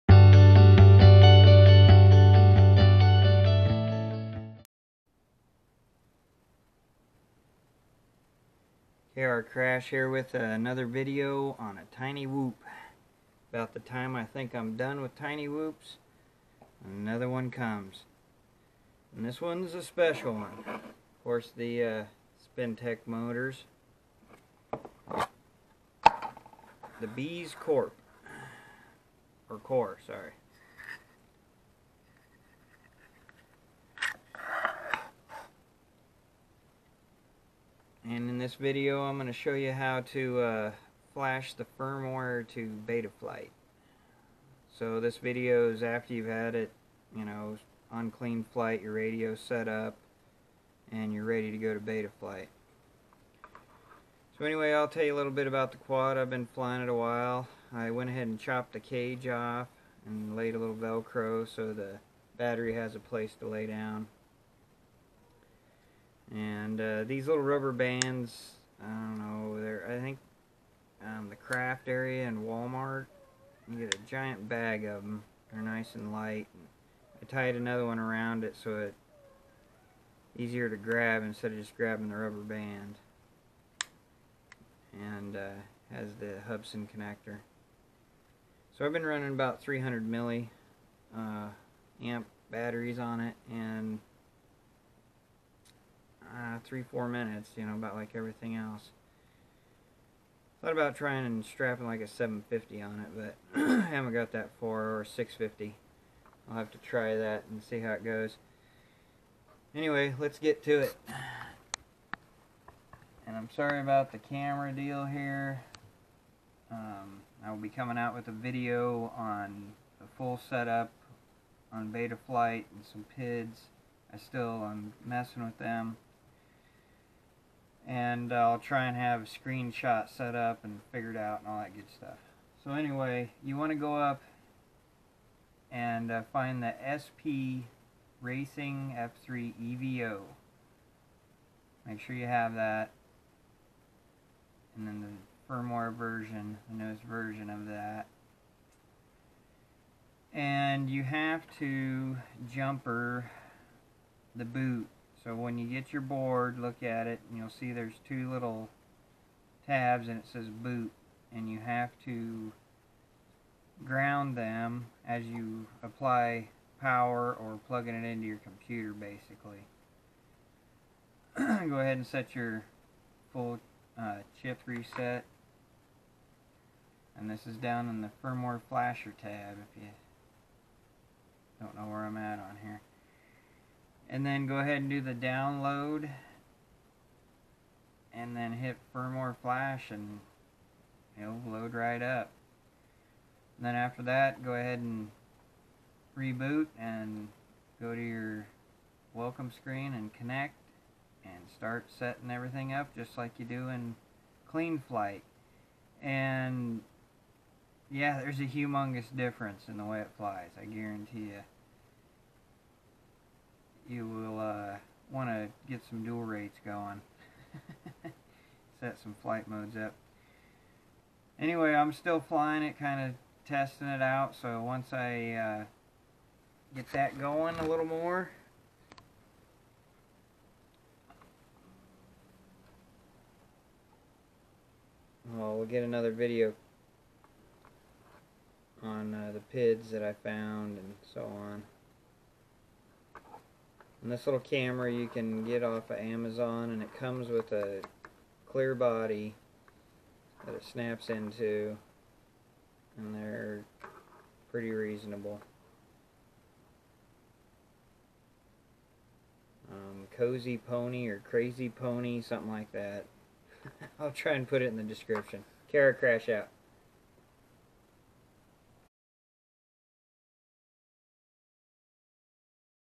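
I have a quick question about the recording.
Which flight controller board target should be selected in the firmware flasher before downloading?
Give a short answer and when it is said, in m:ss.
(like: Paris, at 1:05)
SP Racing F3 EVO, at 2:16.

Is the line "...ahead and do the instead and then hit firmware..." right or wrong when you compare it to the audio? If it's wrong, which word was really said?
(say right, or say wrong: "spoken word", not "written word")
wrong: "download", not "instead".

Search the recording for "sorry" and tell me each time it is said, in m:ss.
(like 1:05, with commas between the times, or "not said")
0:30, 1:53.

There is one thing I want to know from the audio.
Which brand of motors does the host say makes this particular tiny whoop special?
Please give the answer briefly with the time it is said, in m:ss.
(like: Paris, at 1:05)
Spintech, at 0:22.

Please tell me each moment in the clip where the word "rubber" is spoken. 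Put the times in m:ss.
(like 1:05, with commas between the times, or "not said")
1:07, 1:22.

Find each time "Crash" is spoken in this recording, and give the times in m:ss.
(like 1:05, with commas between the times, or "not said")
0:09, 4:25.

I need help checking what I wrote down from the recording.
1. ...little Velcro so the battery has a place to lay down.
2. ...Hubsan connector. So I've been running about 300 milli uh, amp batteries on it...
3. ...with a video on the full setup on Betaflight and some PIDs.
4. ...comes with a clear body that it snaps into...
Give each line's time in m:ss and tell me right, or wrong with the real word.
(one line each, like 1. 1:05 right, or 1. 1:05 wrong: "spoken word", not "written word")
1. 1:00 right
2. 1:26 right
3. 1:58 right
4. 4:06 right.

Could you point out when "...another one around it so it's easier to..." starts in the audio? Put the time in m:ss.
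1:17.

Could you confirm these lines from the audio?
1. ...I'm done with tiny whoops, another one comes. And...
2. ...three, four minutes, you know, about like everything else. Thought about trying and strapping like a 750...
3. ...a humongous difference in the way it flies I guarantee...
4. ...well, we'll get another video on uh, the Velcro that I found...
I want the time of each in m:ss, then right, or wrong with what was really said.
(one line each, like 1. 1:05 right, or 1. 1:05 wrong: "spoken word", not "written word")
1. 0:14 right
2. 1:36 right
3. 3:28 right
4. 3:55 wrong: "PIDs", not "Velcro".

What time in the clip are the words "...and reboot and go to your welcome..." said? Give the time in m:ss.
3:14.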